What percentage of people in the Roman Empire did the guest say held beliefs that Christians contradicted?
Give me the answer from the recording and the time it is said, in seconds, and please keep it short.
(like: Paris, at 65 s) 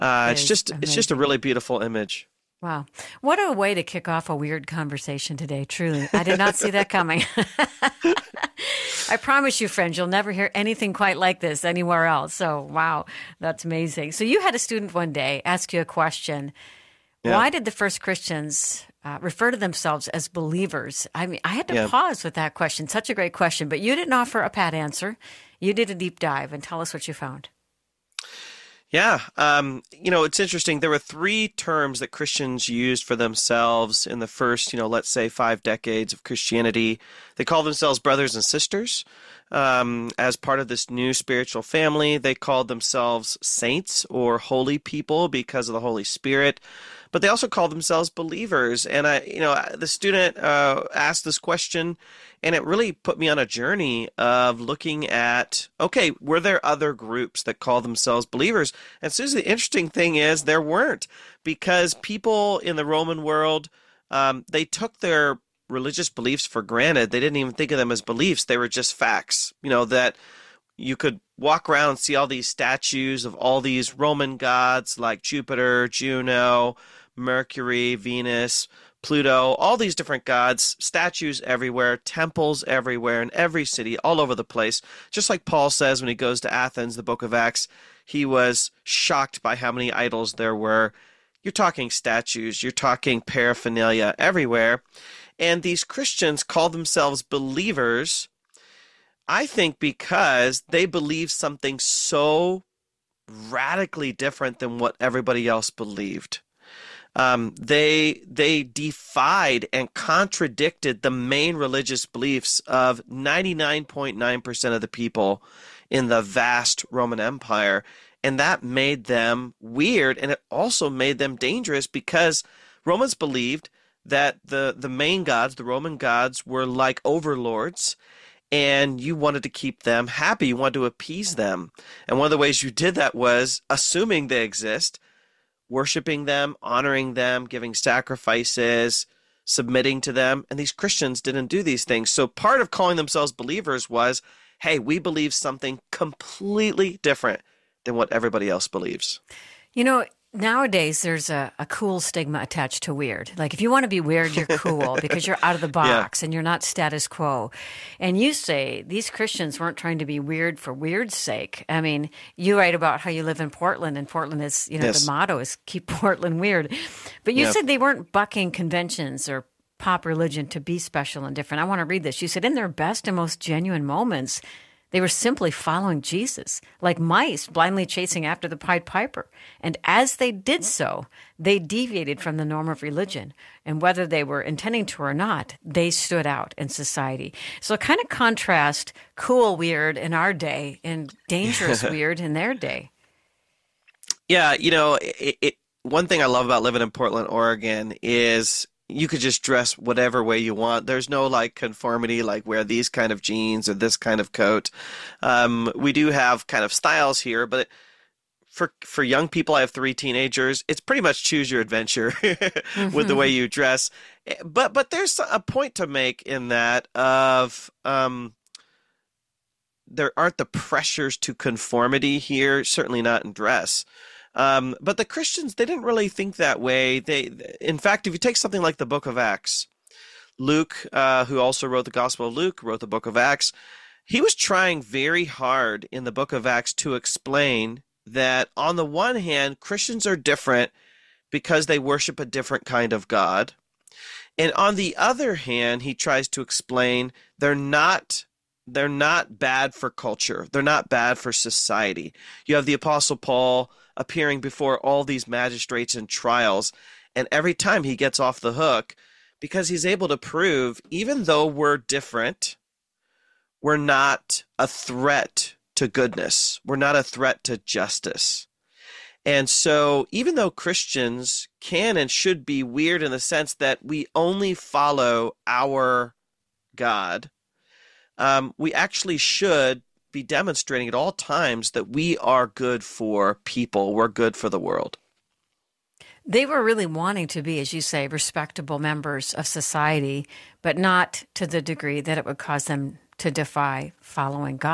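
99.9%, at 113 s.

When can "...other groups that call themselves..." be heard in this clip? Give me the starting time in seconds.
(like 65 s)
56 s.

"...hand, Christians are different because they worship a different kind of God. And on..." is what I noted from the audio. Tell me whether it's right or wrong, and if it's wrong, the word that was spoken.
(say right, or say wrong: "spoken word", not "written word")
right.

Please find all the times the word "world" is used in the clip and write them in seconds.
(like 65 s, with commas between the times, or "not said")
63 s, 284 s.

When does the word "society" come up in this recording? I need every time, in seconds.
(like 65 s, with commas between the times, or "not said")
186 s, 251 s, 289 s.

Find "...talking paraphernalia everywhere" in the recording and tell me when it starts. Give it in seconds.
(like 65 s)
92 s.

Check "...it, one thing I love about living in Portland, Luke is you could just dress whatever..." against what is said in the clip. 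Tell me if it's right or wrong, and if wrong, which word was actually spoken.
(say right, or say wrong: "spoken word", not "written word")
wrong: "Oregon", not "Luke".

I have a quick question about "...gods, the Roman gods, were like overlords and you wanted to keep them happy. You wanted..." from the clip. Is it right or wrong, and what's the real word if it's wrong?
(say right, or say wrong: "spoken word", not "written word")
right.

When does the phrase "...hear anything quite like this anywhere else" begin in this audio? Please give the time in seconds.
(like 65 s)
10 s.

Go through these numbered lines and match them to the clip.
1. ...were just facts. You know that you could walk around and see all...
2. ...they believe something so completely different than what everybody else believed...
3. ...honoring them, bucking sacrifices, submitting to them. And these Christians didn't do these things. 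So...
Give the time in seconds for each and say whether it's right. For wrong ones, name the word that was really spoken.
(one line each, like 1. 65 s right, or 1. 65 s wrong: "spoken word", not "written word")
1. 68 s right
2. 100 s wrong: "radically", not "completely"
3. 136 s wrong: "giving", not "bucking".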